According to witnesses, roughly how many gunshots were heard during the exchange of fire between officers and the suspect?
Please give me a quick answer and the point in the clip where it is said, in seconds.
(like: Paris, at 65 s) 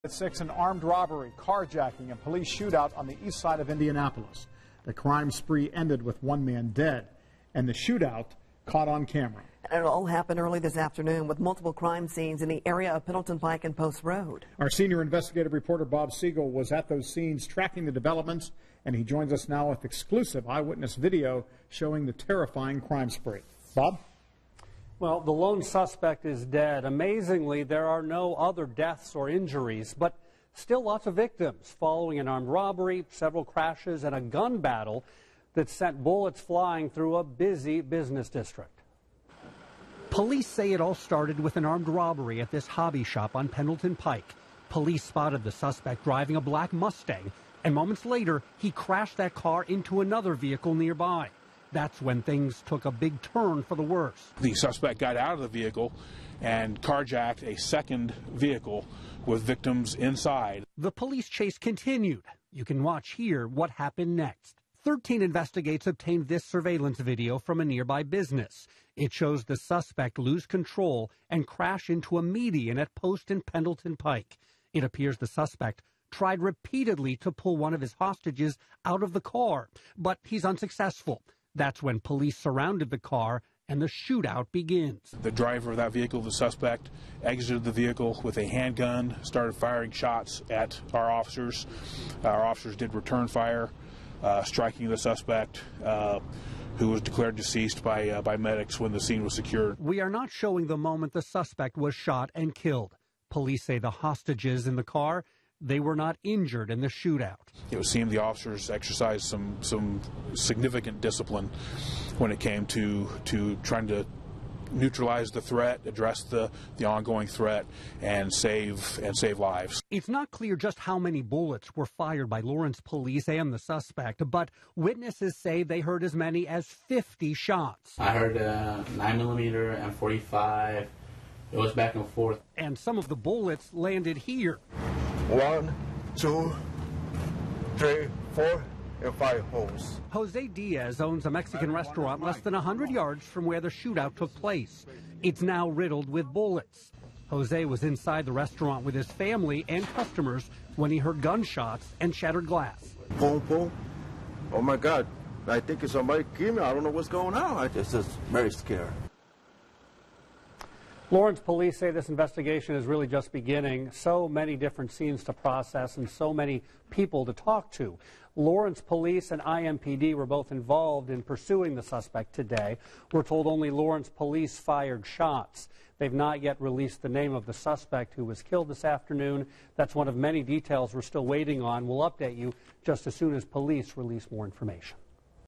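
50, at 126 s.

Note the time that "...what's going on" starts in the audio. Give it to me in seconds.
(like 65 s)
156 s.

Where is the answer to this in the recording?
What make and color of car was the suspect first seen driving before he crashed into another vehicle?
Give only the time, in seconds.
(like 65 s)
46 s.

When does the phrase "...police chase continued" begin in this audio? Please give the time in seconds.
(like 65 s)
60 s.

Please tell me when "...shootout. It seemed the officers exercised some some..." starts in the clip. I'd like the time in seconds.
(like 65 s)
106 s.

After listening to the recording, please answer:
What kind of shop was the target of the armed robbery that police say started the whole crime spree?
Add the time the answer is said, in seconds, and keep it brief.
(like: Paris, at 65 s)
Hobby shop, at 42 s.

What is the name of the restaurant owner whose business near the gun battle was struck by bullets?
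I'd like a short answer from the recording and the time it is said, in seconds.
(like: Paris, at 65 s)
Jose Diaz, at 140 s.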